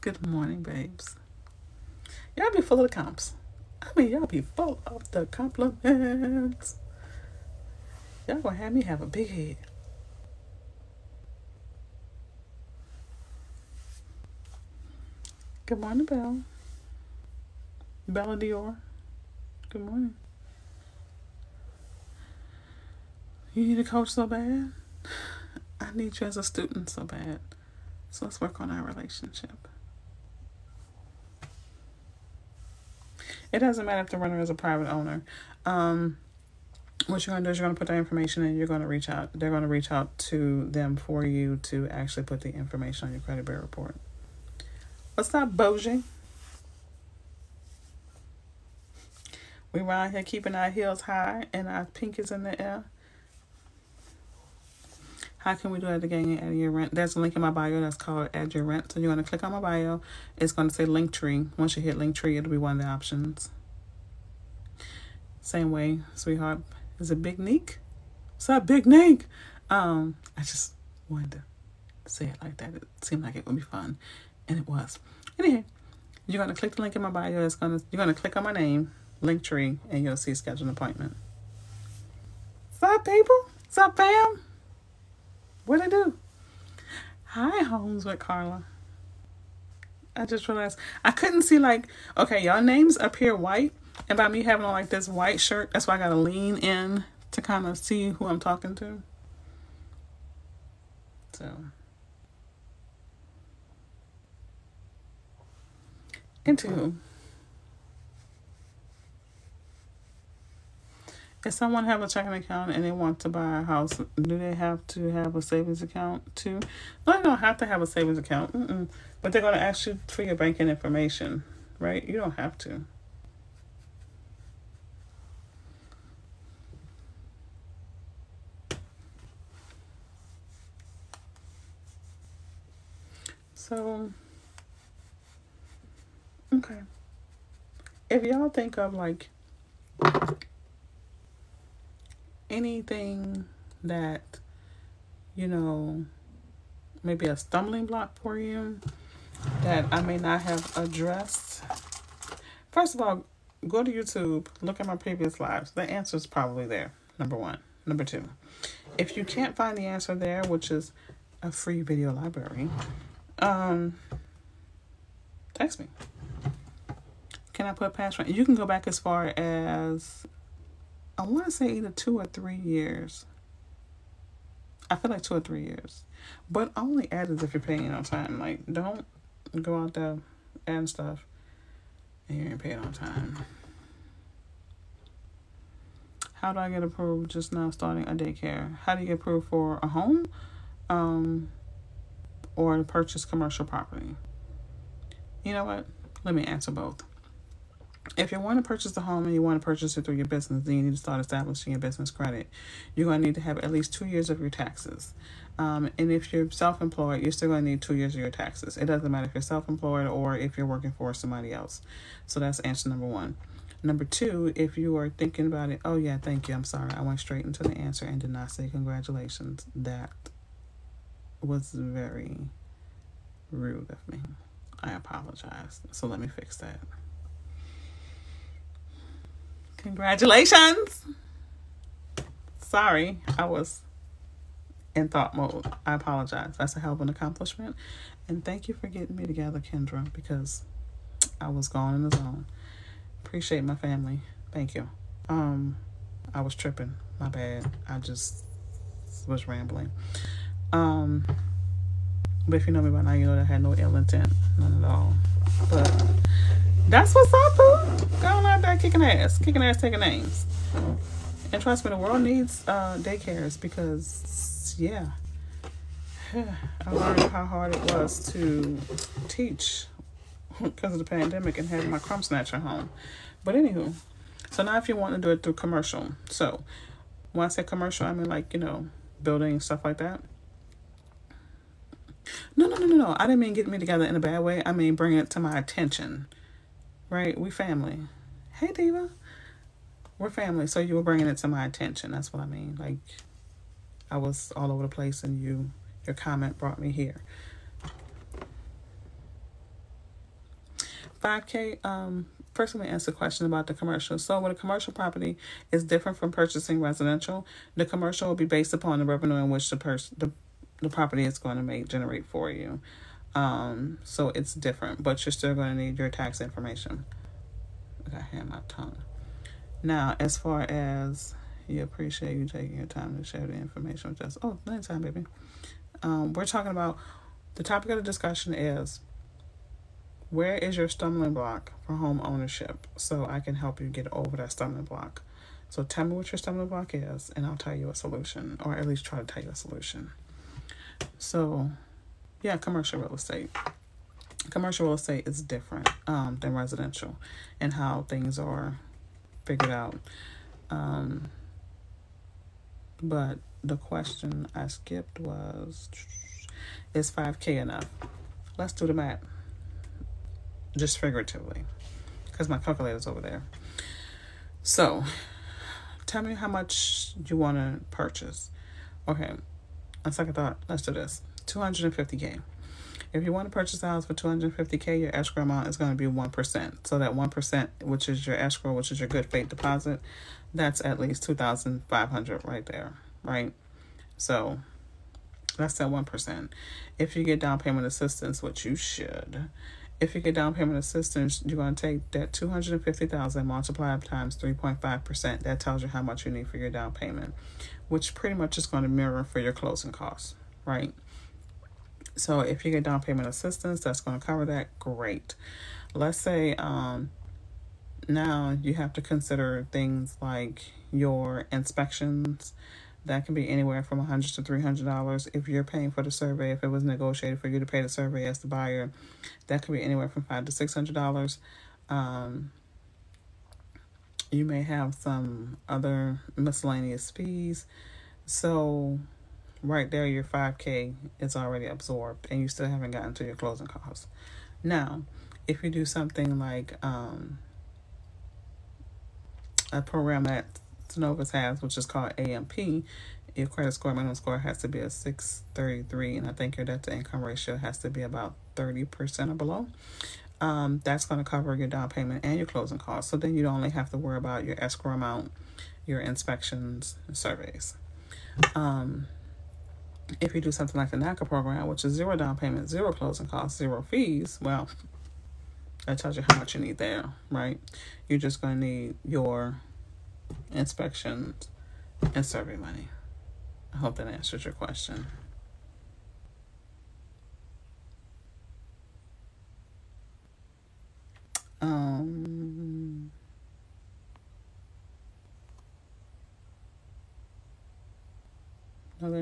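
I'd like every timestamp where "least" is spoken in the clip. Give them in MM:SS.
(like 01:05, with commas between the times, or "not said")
03:23, 05:38, 06:20.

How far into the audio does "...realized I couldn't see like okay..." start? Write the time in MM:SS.
01:30.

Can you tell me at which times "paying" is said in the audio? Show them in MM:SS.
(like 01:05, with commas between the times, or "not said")
02:57, 06:55.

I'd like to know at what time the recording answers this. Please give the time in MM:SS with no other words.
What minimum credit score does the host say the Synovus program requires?
07:24.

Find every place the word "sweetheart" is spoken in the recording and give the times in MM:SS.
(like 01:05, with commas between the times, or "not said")
01:06.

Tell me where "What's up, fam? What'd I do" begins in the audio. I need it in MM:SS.
01:23.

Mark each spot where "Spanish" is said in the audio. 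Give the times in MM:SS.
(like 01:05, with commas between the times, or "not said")
not said.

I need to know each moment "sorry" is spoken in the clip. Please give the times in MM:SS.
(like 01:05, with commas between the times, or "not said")
03:36, 03:52.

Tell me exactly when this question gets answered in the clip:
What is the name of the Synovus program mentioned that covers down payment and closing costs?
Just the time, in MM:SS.
07:22.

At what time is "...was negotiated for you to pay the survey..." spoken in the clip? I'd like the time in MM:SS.
06:56.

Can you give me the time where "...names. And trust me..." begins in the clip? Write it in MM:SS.
04:19.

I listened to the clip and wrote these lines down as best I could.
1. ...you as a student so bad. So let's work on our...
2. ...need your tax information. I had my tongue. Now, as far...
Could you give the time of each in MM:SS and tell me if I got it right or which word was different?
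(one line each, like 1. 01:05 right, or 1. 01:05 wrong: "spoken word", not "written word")
1. 00:26 right
2. 05:15 right.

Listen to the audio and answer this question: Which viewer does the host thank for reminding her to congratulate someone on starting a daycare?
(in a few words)
Kendra.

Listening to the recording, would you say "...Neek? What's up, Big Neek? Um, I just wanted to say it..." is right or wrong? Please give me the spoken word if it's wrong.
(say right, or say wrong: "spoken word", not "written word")
right.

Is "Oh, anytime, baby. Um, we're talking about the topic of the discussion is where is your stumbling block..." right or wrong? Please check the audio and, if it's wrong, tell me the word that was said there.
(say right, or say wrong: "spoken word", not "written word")
right.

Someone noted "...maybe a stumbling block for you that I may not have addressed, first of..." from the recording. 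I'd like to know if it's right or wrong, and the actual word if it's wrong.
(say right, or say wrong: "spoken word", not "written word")
right.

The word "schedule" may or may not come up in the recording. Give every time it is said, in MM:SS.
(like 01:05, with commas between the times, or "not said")
01:20.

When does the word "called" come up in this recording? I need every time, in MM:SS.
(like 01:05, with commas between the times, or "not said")
00:57, 07:21.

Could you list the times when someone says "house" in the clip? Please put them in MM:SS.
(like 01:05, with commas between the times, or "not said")
01:53, 06:13.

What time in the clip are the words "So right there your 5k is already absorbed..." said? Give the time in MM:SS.
07:08.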